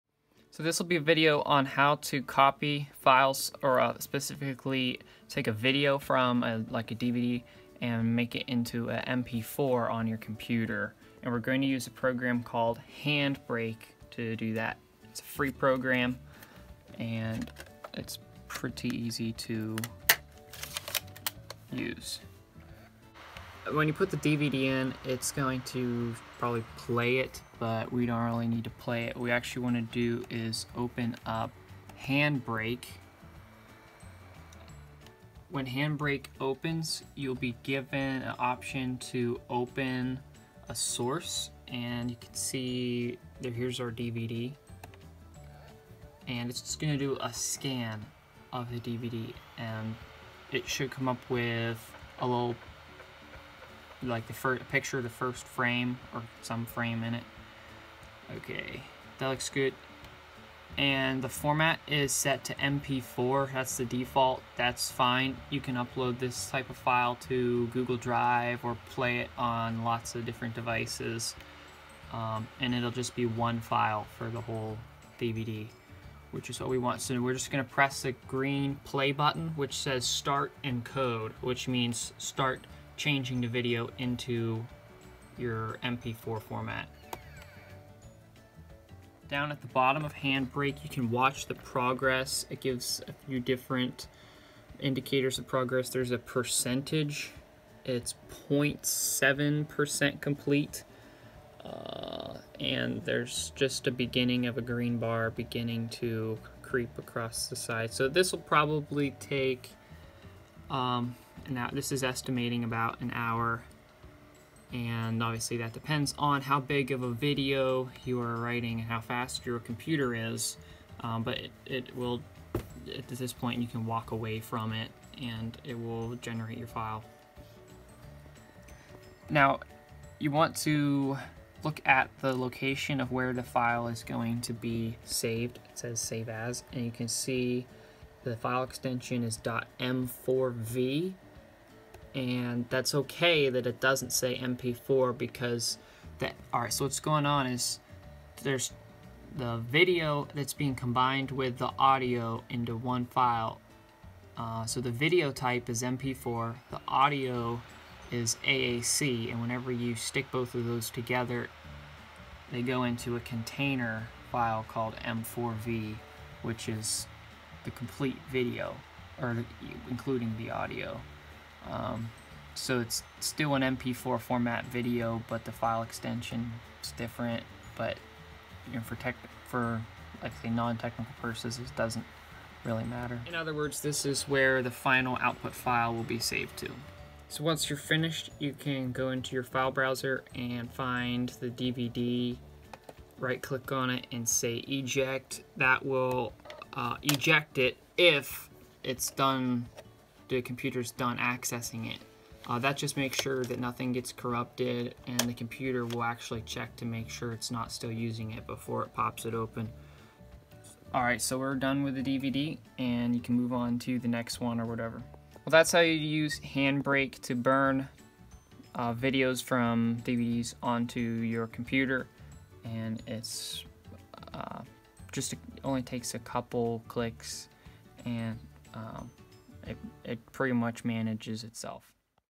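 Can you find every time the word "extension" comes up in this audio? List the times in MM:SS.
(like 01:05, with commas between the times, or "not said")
02:18, 02:55.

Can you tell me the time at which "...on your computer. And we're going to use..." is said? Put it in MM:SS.
00:09.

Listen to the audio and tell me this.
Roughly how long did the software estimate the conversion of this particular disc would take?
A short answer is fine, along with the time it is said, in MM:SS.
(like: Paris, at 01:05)
about an hour, at 01:52.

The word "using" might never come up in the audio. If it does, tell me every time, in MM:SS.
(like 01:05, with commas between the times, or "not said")
03:27.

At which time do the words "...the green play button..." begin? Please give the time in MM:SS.
01:18.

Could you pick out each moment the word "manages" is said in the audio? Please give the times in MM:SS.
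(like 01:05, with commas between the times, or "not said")
03:50.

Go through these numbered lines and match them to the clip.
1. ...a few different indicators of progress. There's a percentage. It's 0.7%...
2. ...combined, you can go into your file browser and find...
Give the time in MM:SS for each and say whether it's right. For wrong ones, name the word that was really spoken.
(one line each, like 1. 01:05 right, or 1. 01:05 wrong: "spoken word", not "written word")
1. 01:33 right
2. 03:07 wrong: "finished", not "combined".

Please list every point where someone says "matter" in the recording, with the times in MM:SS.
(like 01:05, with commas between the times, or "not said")
03:02.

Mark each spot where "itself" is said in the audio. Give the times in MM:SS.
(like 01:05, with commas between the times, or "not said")
03:51.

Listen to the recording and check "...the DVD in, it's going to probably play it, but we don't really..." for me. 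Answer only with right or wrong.
right.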